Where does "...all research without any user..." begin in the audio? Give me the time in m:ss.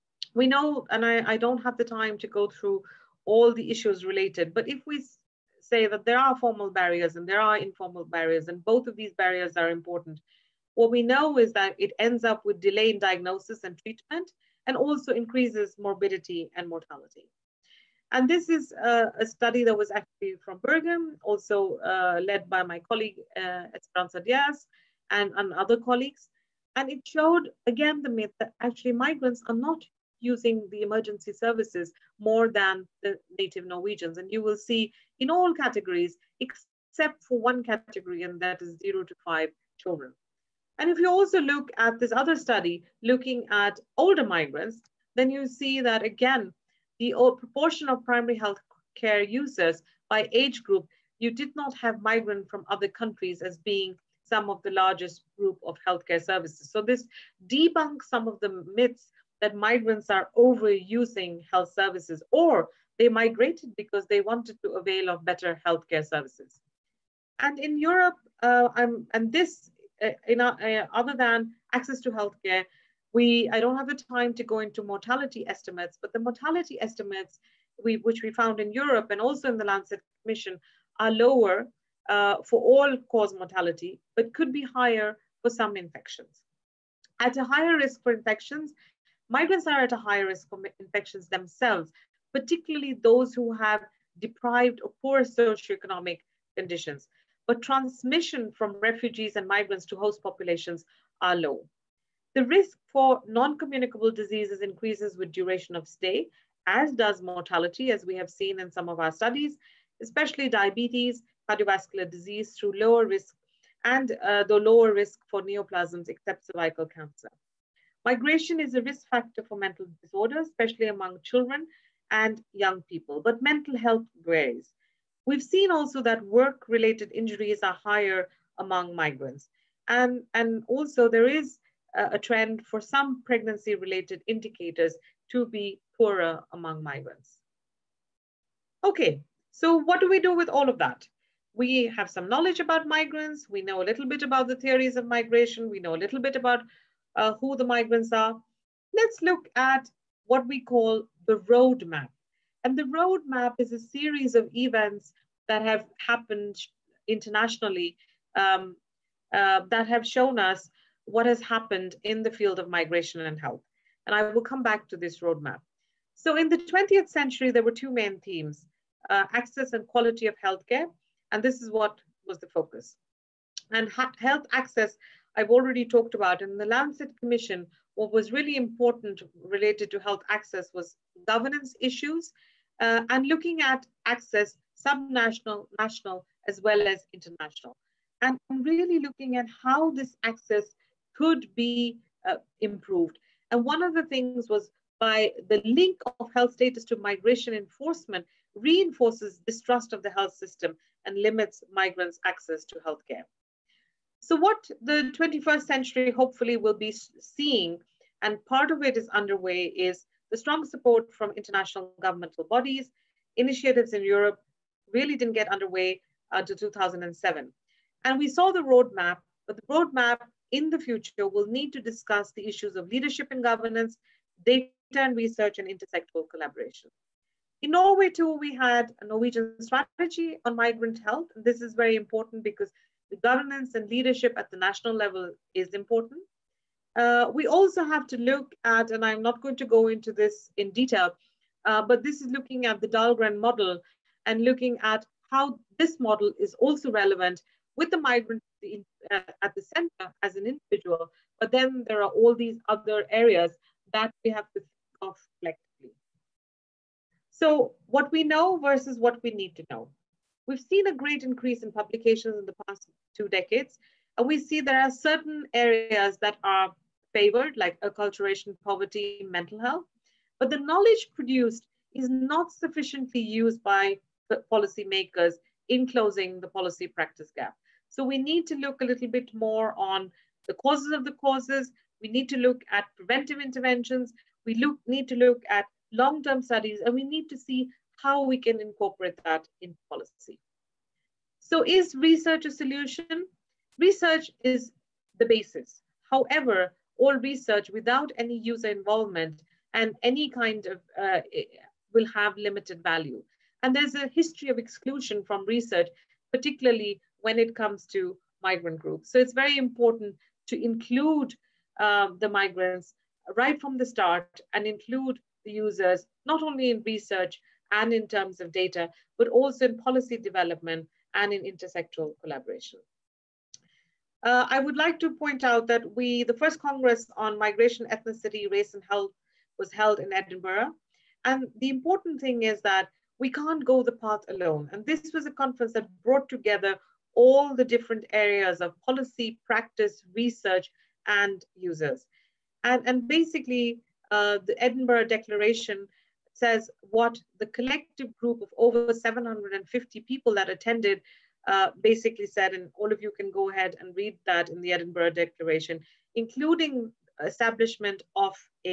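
4:56.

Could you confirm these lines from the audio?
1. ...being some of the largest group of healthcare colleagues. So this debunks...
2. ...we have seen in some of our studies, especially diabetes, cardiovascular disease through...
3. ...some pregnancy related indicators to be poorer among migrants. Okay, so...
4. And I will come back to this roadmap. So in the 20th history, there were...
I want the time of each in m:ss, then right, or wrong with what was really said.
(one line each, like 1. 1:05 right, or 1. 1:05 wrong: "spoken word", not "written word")
1. 0:53 wrong: "services", not "colleagues"
2. 1:48 right
3. 2:12 right
4. 2:44 wrong: "century", not "history".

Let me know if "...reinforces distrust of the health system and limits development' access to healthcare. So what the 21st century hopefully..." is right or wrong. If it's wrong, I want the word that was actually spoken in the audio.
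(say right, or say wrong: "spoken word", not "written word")
wrong: "migrants", not "development".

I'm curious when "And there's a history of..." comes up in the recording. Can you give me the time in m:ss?
5:03.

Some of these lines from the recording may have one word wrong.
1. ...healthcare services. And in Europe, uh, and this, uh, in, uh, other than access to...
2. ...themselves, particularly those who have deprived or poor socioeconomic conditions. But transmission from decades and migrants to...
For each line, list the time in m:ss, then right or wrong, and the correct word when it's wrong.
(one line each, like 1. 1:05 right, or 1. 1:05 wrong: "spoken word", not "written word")
1. 1:05 right
2. 1:31 wrong: "refugees", not "decades".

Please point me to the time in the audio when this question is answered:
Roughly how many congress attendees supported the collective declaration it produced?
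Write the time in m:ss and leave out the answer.
5:48.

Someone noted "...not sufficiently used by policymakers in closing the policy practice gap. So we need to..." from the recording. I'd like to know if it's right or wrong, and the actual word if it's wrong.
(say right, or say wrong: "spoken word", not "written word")
right.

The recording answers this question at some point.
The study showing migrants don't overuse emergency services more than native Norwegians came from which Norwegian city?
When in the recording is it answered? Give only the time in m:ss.
0:20.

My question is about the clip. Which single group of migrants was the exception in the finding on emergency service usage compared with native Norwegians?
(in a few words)
0 to 5 children.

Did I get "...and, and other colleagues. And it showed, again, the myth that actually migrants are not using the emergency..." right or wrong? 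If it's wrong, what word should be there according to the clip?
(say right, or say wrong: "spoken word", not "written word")
right.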